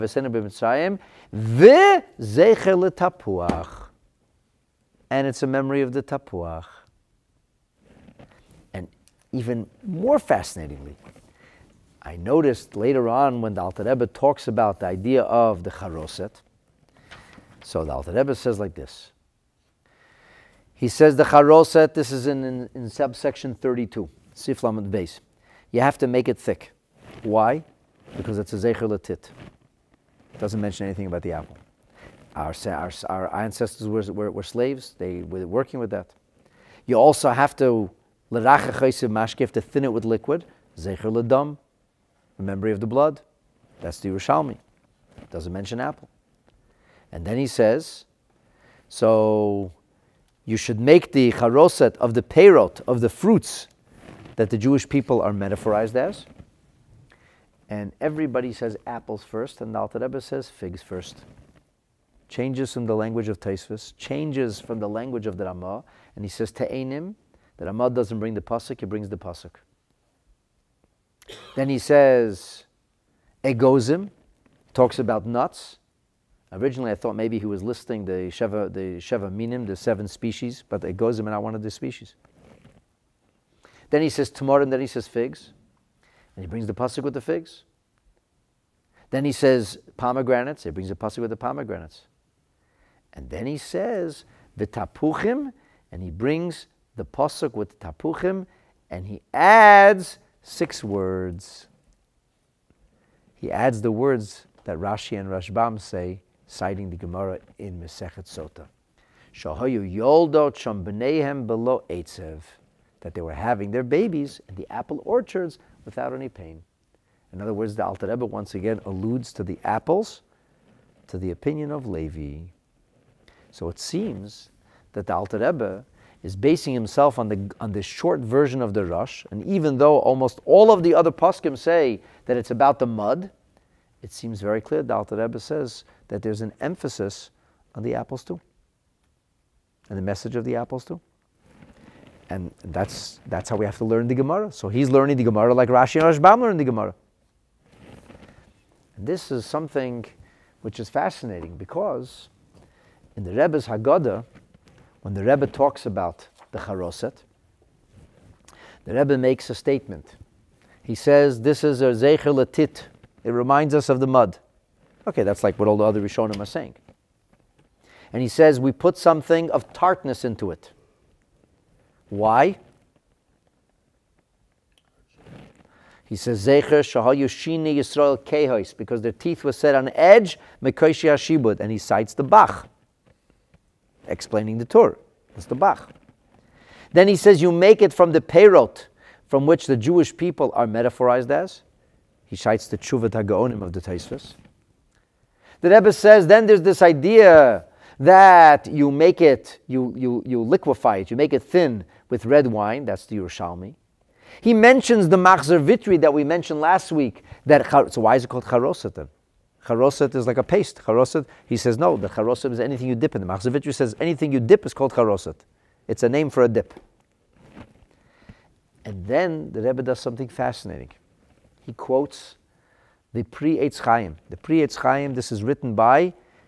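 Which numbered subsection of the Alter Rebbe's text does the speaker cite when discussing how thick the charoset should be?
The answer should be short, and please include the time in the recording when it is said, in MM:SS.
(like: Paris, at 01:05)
32, at 00:23.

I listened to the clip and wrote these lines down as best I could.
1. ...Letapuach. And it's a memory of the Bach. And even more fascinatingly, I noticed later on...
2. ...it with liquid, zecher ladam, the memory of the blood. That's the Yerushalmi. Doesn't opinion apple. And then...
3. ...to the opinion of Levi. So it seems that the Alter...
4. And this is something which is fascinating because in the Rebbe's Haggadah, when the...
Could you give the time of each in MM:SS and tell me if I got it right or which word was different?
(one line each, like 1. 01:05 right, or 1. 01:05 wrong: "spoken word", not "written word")
1. 00:02 wrong: "Tapuach", not "Bach"
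2. 00:39 wrong: "mention", not "opinion"
3. 02:01 right
4. 02:28 right.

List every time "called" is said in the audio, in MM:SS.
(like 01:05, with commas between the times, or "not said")
03:28, 03:34.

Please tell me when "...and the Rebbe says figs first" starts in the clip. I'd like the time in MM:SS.
00:59.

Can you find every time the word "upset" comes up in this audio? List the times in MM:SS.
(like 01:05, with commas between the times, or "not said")
not said.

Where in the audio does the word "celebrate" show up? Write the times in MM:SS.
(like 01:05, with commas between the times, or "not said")
not said.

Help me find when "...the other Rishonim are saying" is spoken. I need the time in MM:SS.
02:45.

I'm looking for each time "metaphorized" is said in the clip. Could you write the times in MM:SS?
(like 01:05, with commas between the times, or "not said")
00:55, 03:10.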